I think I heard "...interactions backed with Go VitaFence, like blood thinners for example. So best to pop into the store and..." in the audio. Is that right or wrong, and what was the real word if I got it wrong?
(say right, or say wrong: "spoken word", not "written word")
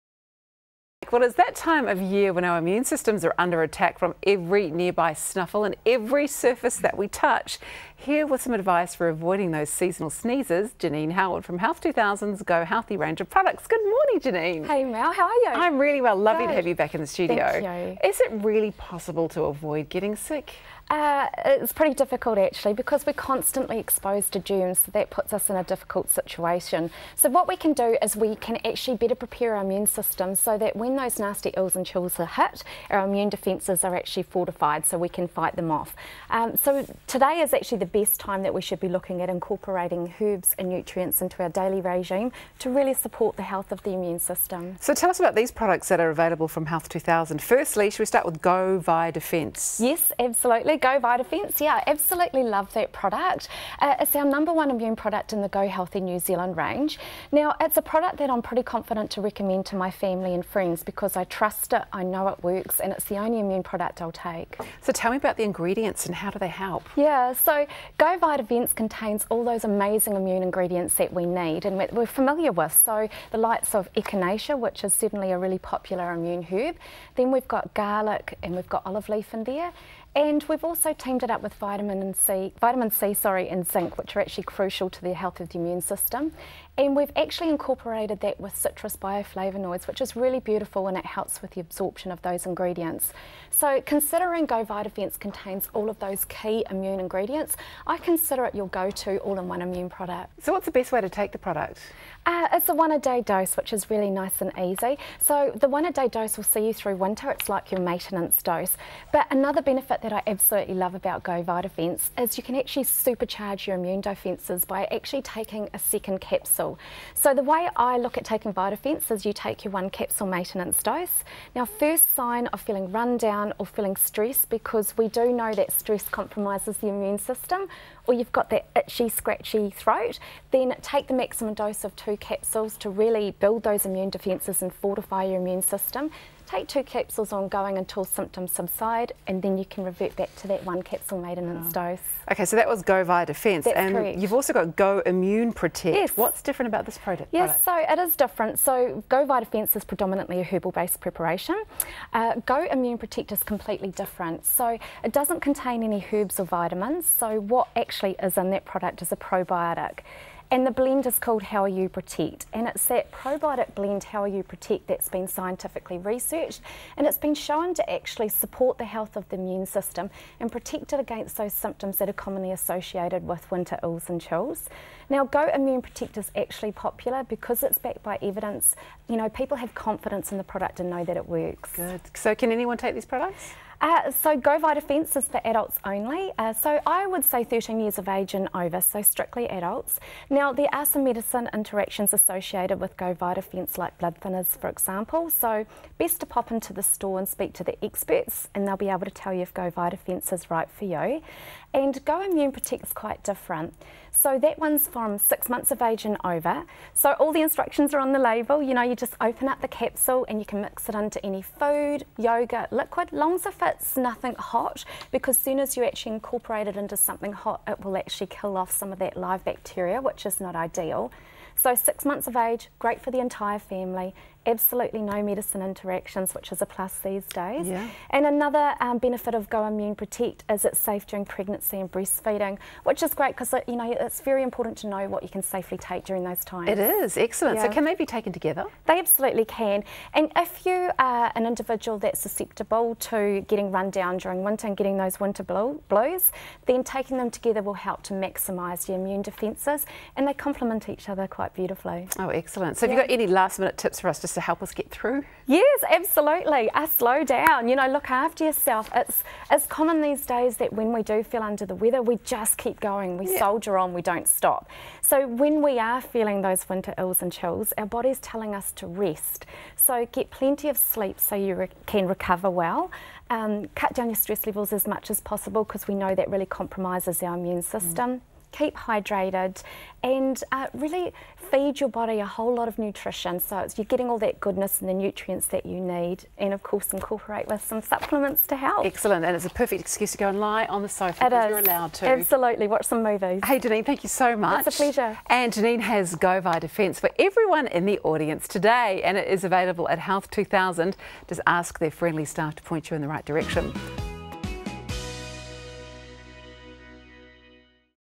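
wrong: "associated", not "backed".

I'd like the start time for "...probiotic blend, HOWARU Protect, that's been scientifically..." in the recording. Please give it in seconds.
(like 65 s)
163 s.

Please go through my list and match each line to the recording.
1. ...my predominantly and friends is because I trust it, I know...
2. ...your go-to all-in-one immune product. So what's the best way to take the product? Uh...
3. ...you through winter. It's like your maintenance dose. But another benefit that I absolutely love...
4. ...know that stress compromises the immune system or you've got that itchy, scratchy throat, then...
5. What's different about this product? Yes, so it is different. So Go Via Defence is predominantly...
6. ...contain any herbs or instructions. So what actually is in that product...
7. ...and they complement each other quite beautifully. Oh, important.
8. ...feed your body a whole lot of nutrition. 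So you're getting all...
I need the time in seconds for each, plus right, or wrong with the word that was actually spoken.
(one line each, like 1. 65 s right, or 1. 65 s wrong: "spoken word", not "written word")
1. 59 s wrong: "family", not "predominantly"
2. 98 s right
3. 106 s right
4. 125 s right
5. 146 s right
6. 155 s wrong: "vitamins", not "instructions"
7. 250 s wrong: "excellent", not "important"
8. 281 s right.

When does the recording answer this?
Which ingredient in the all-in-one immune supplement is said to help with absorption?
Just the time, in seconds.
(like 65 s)
88 s.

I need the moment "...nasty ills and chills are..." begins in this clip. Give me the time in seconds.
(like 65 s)
31 s.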